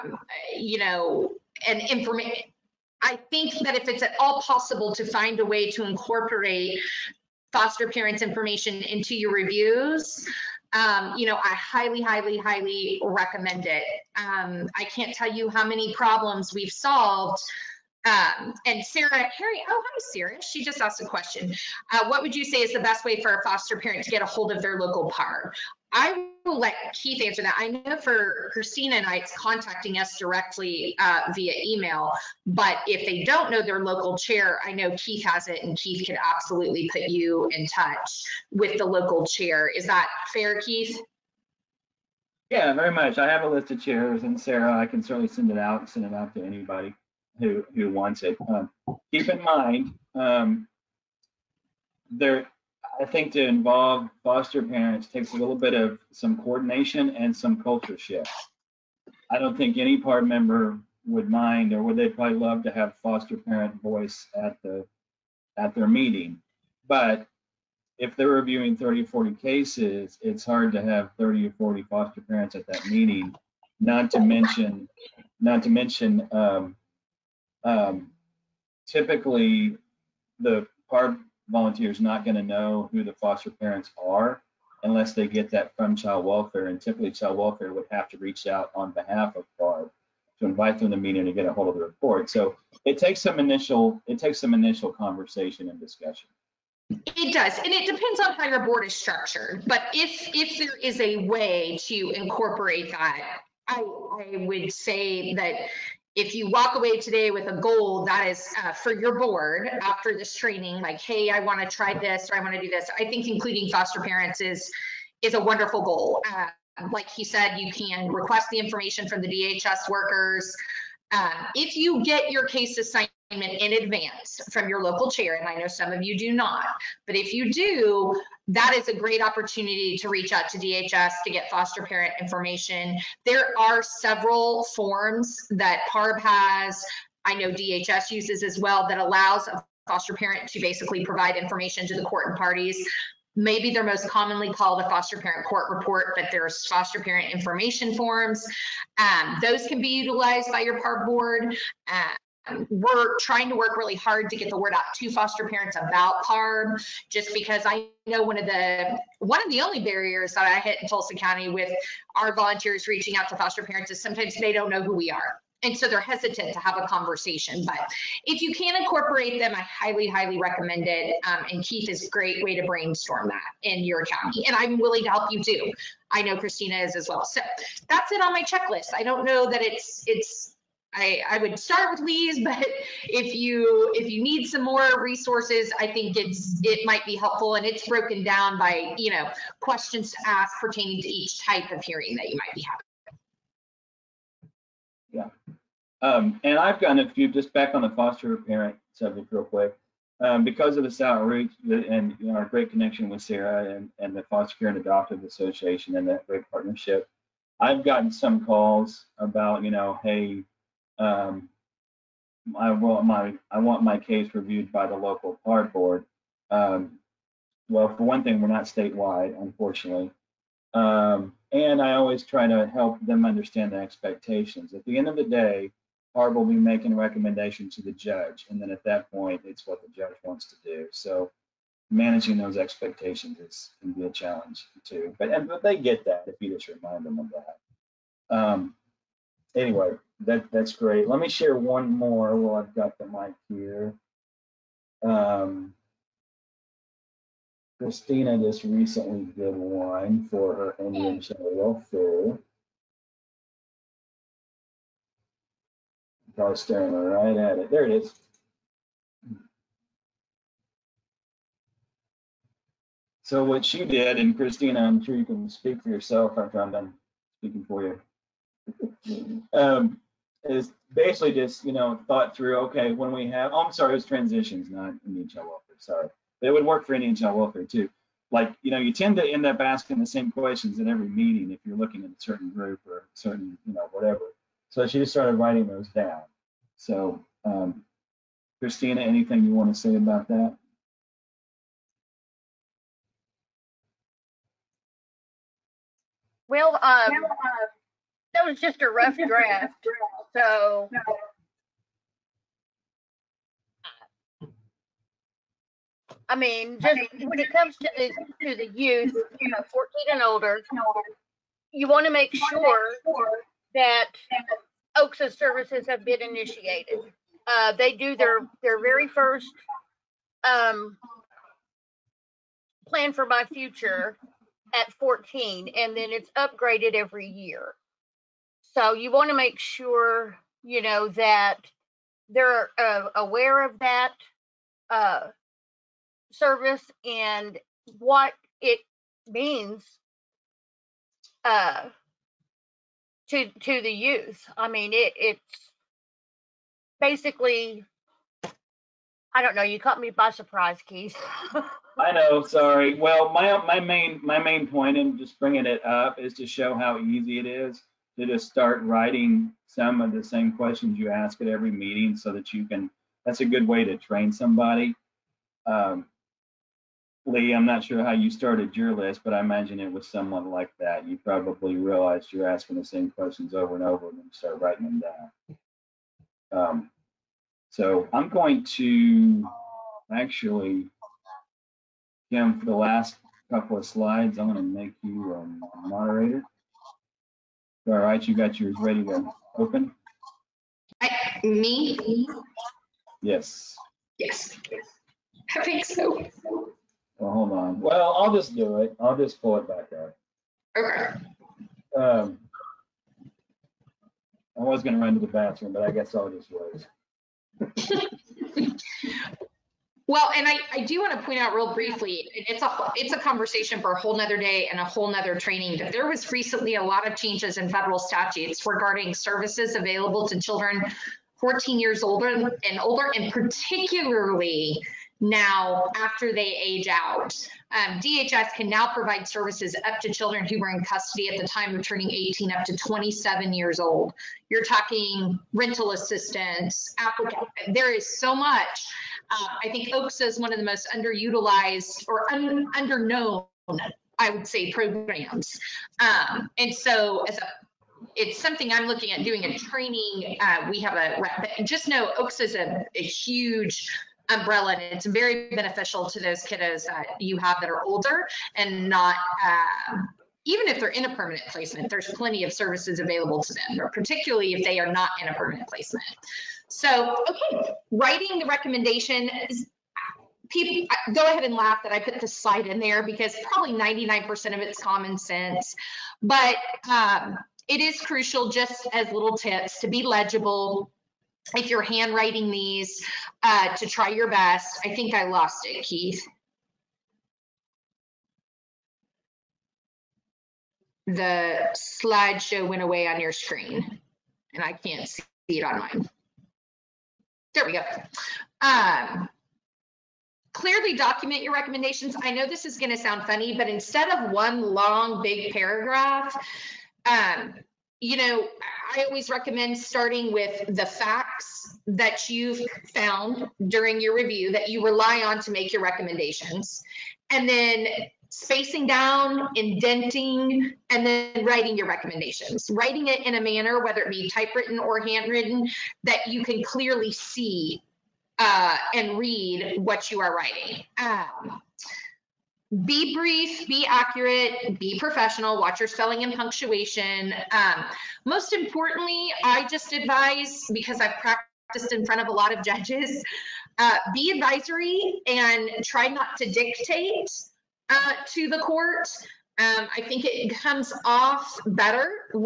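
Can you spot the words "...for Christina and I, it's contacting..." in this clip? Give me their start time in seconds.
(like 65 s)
27 s.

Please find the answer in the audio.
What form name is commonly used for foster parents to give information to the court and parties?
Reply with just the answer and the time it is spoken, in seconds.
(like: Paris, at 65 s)
foster parent court report, at 144 s.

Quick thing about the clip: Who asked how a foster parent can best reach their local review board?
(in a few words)
Sarah Harry.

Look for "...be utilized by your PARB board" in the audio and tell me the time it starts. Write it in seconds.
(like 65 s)
149 s.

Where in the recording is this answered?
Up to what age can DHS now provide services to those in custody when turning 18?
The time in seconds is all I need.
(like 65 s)
432 s.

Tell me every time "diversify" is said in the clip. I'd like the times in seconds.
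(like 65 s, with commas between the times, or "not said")
not said.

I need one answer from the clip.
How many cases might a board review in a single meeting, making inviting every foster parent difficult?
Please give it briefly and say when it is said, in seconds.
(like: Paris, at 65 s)
30 40, at 68 s.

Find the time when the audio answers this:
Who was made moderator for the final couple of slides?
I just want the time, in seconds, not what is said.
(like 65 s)
382 s.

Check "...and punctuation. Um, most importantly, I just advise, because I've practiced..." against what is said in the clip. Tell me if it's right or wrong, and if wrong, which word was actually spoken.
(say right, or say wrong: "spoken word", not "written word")
right.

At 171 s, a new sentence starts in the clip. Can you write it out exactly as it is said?
Um, and Keith is a great way to brainstorm that in your county.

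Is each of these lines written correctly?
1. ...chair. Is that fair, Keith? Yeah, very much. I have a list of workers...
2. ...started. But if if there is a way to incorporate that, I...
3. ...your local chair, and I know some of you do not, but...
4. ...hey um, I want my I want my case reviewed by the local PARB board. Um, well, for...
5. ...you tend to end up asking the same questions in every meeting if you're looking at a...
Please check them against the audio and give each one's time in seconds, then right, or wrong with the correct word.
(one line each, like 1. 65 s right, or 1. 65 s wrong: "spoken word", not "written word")
1. 39 s wrong: "chairs", not "workers"
2. 98 s wrong: "structured", not "started"
3. 124 s right
4. 210 s right
5. 278 s right.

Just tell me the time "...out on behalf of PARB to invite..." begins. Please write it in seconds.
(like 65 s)
88 s.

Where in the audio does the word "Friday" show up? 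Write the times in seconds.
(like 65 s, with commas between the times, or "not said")
not said.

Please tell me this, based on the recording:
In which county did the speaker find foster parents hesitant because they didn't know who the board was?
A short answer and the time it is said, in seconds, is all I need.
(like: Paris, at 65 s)
Tulsa County, at 160 s.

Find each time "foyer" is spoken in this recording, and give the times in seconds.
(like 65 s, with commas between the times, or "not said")
not said.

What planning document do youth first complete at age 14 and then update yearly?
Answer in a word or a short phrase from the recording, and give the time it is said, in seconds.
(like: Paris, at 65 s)
plan for my future, at 322 s.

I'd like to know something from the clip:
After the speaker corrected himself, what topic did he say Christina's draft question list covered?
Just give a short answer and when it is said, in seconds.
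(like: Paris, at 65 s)
transitions, at 274 s.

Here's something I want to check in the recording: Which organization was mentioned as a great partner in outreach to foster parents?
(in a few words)
Foster Care and Adoptive Association.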